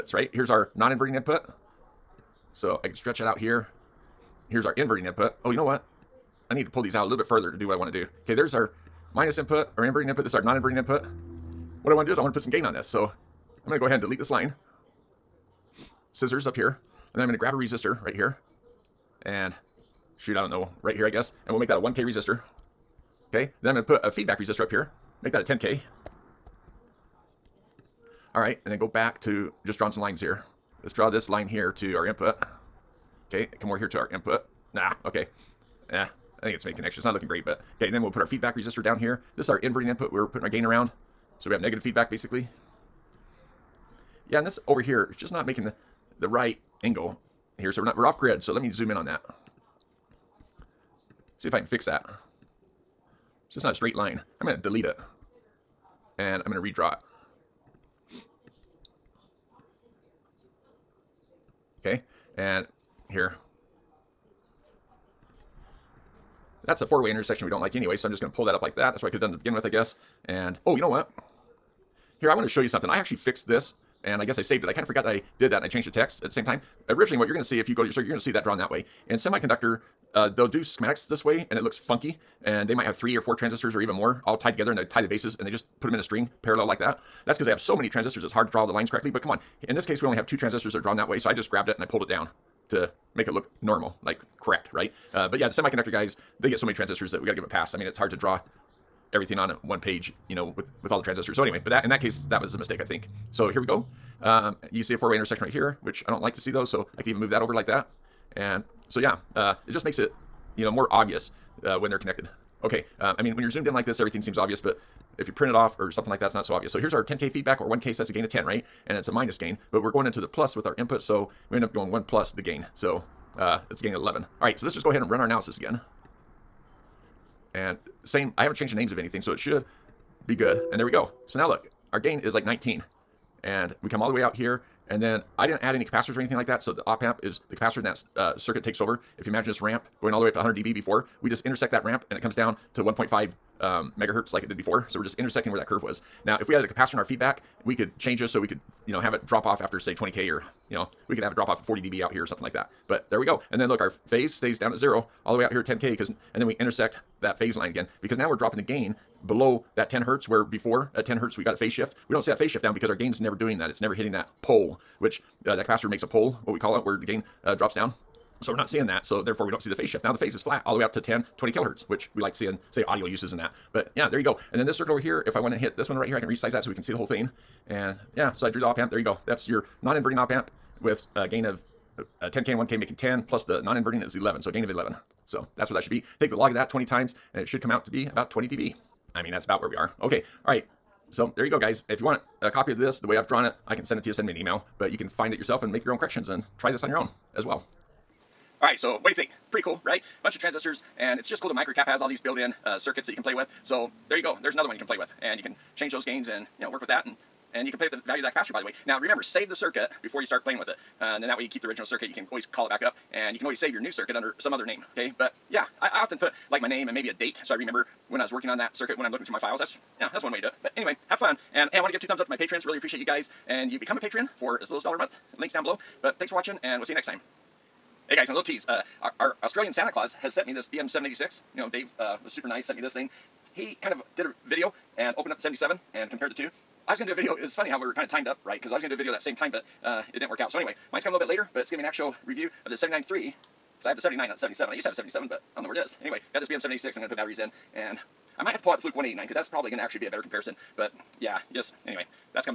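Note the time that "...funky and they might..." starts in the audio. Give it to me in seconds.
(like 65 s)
81 s.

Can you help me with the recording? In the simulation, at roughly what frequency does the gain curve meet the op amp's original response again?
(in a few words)
1.5 megahertz.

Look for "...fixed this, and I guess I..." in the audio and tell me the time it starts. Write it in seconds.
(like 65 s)
73 s.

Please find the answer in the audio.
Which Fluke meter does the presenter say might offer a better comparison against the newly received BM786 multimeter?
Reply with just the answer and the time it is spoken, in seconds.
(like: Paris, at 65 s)
Fluke 189, at 248 s.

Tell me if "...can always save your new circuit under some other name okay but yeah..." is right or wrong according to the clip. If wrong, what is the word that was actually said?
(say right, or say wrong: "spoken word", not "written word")
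right.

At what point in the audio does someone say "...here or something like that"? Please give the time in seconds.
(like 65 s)
152 s.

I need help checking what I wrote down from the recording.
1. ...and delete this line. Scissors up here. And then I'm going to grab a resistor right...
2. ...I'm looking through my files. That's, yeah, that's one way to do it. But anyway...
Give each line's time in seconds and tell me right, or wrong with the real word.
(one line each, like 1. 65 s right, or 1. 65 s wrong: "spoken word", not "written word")
1. 13 s right
2. 219 s right.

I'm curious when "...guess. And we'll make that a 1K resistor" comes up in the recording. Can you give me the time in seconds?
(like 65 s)
21 s.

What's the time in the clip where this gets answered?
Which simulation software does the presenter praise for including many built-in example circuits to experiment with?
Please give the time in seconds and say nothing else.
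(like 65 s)
201 s.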